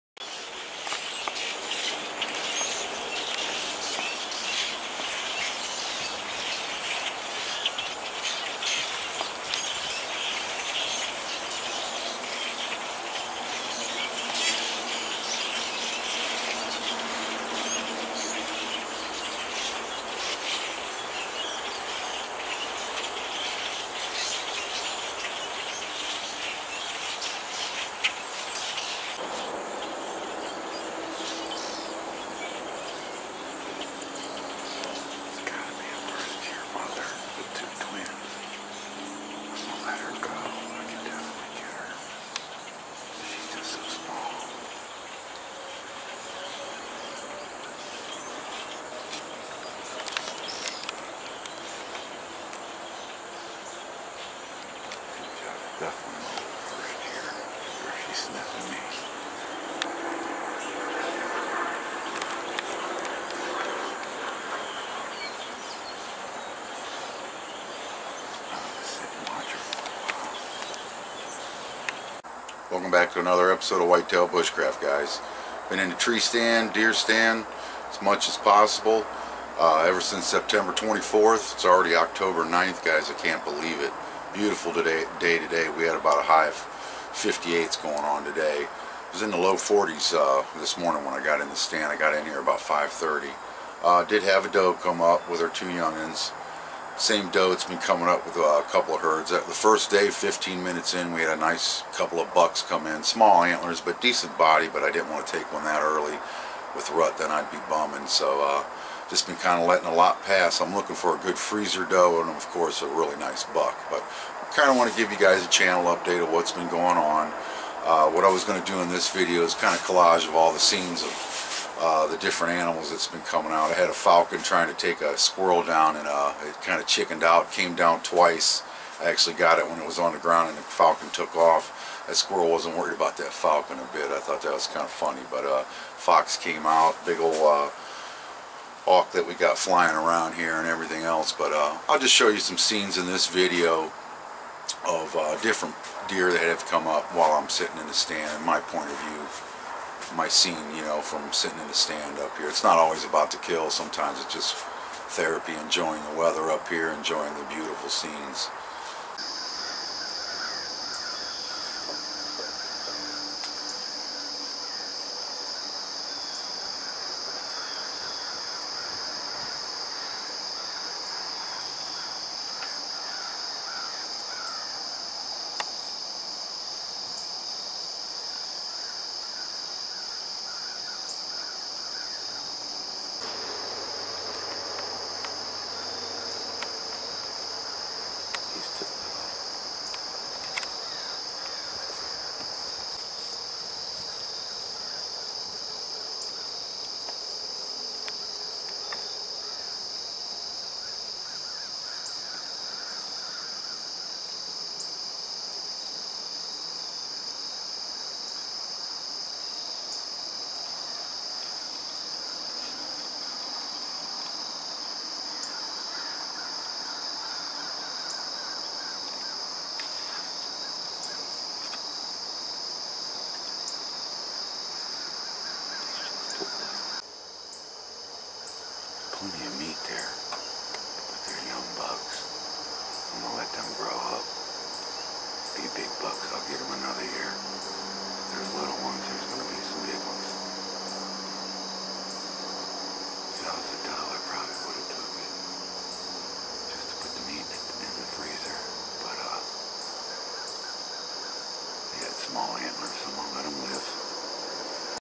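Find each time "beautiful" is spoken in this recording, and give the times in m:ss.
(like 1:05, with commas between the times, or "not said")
1:24, 2:37.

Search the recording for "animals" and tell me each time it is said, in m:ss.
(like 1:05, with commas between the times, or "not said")
2:02, 4:12.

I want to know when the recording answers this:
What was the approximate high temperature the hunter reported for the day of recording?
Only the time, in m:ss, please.
1:27.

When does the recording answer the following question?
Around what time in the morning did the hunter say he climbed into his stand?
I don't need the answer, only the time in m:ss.
1:32.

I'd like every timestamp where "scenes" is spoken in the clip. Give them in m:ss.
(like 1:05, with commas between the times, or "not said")
2:00, 2:22, 2:30, 2:37.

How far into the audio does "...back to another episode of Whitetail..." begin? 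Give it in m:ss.
1:12.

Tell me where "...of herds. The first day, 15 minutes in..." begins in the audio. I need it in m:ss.
1:38.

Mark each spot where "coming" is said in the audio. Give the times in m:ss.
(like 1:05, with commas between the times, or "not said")
1:37, 2:03.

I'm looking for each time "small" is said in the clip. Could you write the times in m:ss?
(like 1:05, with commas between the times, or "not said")
1:43, 4:12.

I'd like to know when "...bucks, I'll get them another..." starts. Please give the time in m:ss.
3:56.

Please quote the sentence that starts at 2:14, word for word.
I thought that was kind of funny.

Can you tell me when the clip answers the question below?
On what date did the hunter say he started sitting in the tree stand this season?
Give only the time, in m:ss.
1:20.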